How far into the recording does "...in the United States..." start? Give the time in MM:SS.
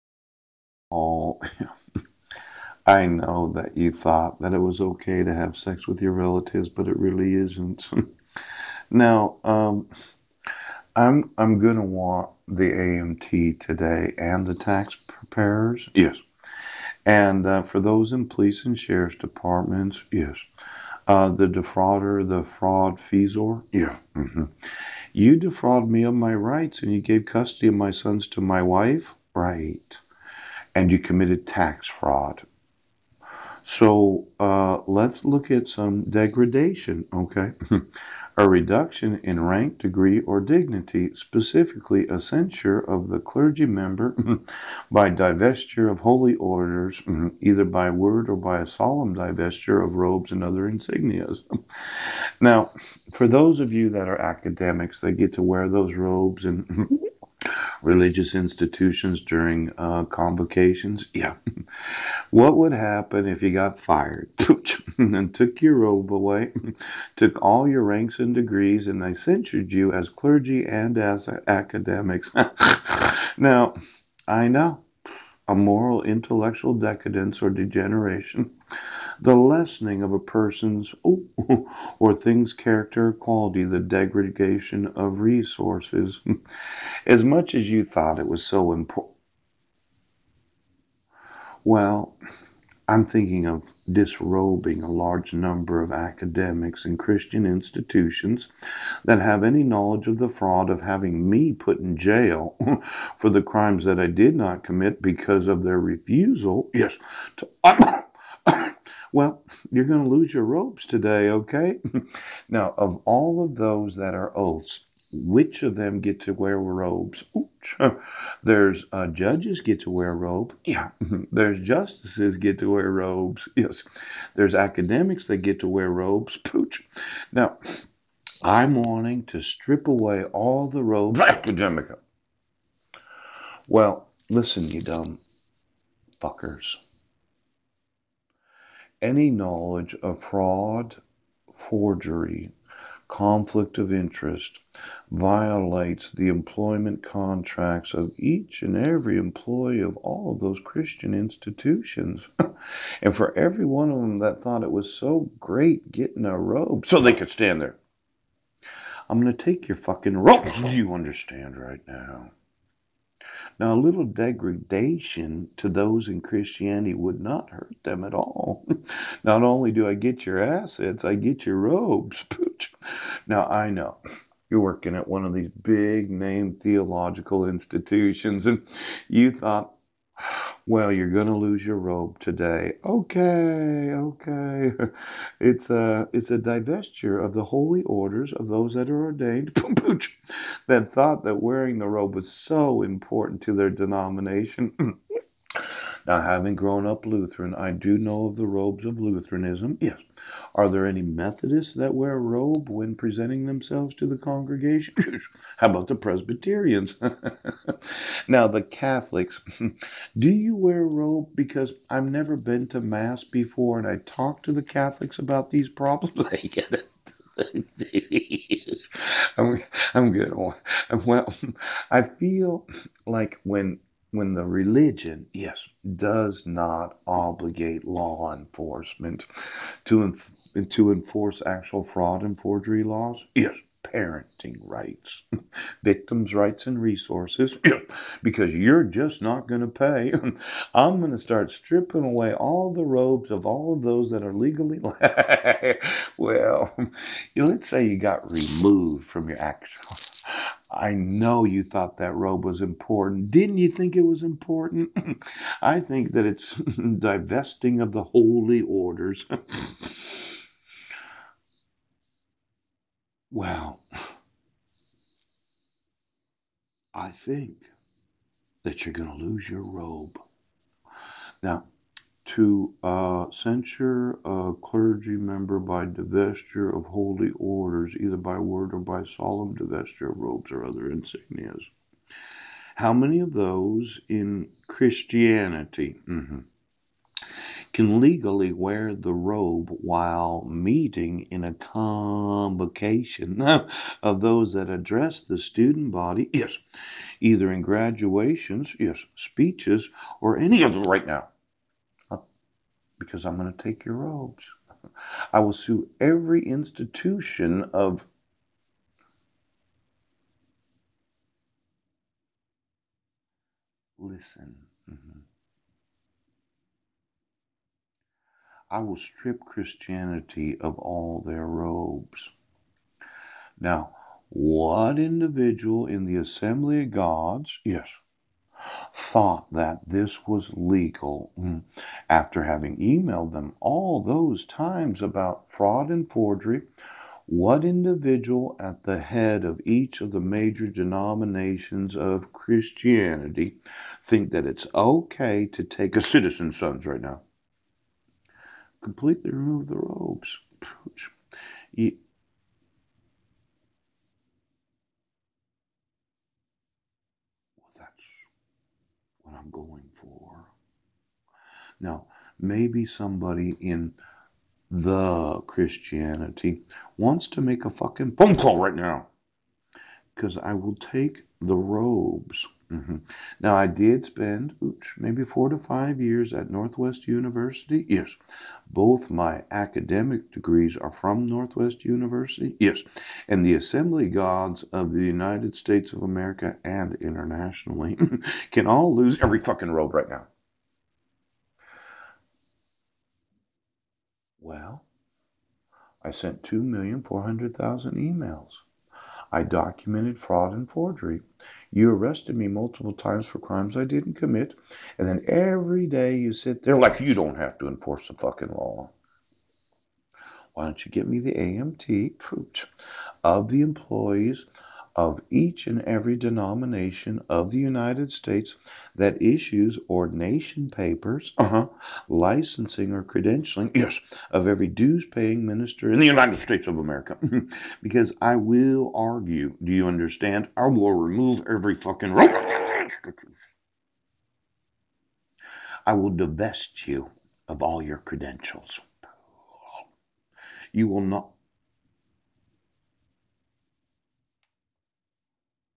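07:05.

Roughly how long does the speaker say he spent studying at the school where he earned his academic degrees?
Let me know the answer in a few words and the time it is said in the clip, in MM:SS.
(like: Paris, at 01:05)
4 to 5 years, at 06:15.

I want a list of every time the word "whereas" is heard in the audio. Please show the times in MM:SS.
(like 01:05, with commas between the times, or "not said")
not said.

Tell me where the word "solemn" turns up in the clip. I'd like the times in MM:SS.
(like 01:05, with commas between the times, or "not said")
00:48, 04:39.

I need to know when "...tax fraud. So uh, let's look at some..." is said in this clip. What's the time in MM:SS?
00:31.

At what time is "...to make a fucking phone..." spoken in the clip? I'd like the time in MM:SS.
06:07.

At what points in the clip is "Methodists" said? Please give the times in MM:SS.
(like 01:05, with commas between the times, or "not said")
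03:21.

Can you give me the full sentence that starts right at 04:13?
Didn't you think it was important?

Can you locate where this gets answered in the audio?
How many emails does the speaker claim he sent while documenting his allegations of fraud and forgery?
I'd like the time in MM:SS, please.
06:36.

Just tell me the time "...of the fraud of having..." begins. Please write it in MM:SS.
01:40.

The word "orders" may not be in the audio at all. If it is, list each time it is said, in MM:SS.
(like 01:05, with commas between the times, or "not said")
00:46, 03:07, 04:18, 04:37.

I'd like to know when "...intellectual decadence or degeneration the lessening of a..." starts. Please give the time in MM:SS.
01:16.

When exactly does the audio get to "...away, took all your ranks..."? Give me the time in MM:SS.
01:06.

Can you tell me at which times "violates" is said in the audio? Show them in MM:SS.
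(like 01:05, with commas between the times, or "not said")
02:25.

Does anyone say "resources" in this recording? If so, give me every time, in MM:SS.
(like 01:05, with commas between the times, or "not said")
01:25, 03:56.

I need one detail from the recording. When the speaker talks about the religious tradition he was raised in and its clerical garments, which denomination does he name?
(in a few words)
Lutheran.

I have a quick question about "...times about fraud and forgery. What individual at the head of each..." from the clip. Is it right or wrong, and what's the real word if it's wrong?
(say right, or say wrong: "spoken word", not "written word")
right.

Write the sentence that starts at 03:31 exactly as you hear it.
Because I've never been to Mass before and I talk to the Catholics about these problems.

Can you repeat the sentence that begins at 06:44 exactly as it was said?
And then every day you sit there like you don't have to enforce the fucking law.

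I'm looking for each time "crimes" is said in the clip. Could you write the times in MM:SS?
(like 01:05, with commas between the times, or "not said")
01:43, 06:43.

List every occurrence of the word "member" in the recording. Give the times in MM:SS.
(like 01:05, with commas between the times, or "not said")
00:43, 04:35.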